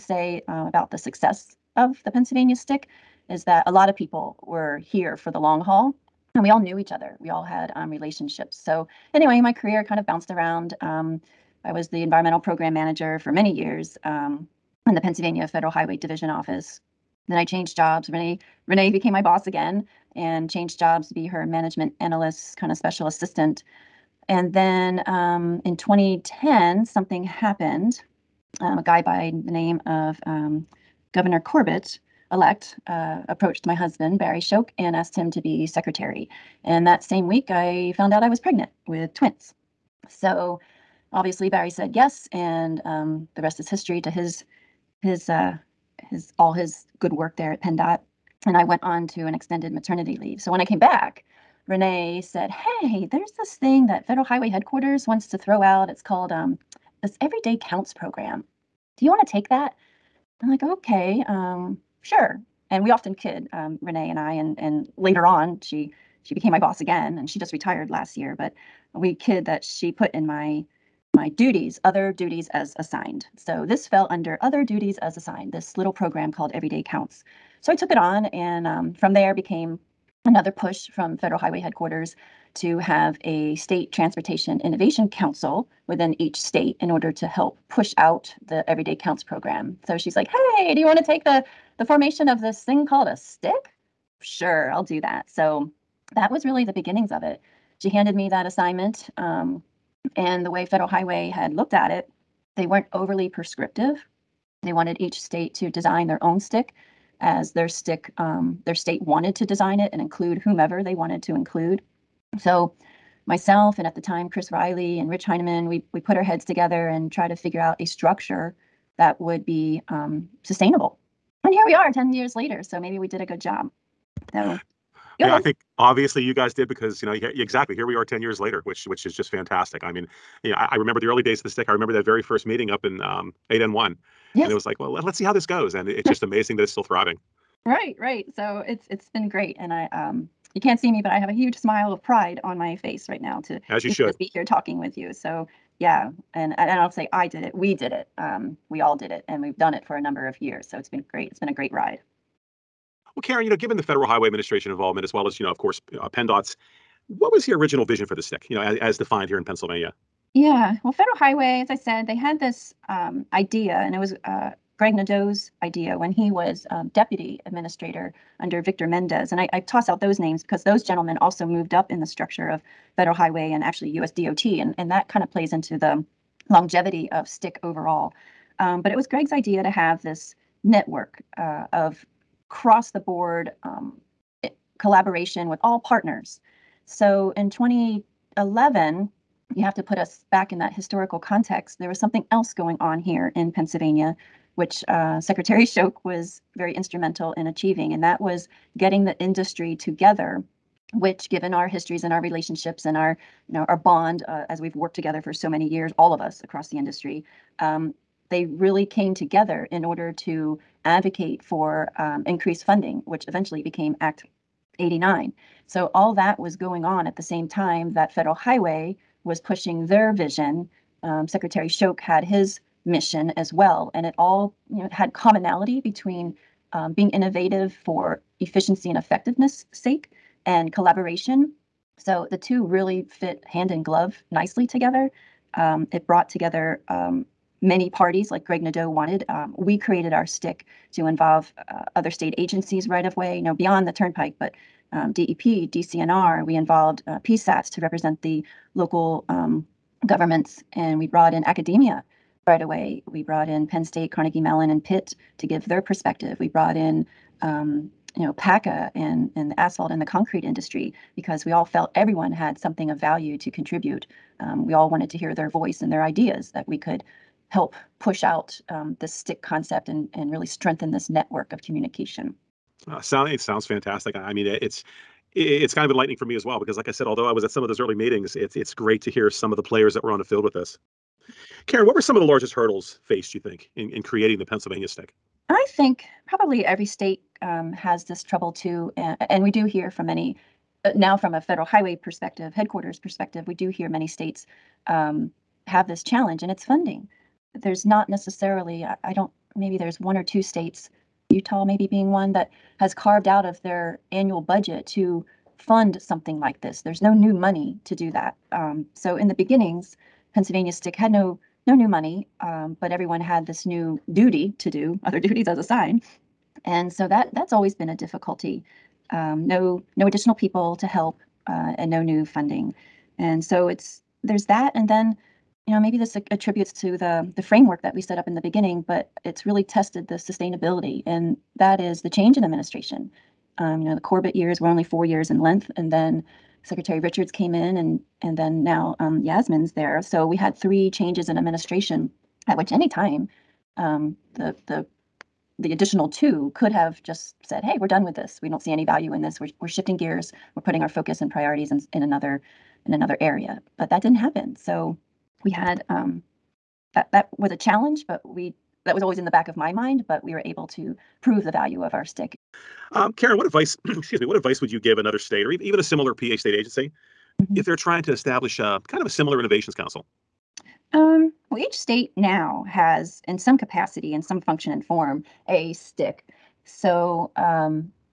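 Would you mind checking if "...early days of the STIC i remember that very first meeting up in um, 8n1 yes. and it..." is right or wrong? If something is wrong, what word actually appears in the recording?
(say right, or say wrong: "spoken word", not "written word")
right.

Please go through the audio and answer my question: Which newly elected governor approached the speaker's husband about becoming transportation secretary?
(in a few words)
Governor Corbett.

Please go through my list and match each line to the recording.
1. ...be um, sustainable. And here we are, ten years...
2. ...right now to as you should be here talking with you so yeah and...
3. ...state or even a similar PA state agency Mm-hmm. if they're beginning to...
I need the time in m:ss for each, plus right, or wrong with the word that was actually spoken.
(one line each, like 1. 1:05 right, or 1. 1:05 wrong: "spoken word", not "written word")
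1. 1:59 right
2. 2:23 right
3. 6:05 wrong: "trying", not "beginning".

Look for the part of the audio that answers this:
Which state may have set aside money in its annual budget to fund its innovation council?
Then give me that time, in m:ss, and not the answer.
5:01.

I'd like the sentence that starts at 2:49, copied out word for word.
And I, I toss out those names because those gentlemen also moved up in the structure of federal highway and actually USDOT.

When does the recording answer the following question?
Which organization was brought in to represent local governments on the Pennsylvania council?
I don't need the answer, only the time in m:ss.
4:07.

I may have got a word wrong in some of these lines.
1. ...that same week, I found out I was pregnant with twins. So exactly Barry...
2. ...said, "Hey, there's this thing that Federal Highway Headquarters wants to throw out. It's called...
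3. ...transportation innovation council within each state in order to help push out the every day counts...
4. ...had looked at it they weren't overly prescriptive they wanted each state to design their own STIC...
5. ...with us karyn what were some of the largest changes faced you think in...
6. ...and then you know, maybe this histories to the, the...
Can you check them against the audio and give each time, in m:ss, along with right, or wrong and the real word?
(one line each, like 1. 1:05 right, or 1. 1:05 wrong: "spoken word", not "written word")
1. 0:36 wrong: "obviously", not "exactly"
2. 0:52 right
3. 1:23 right
4. 1:41 right
5. 4:40 wrong: "hurdles", not "changes"
6. 5:24 wrong: "attributes", not "histories".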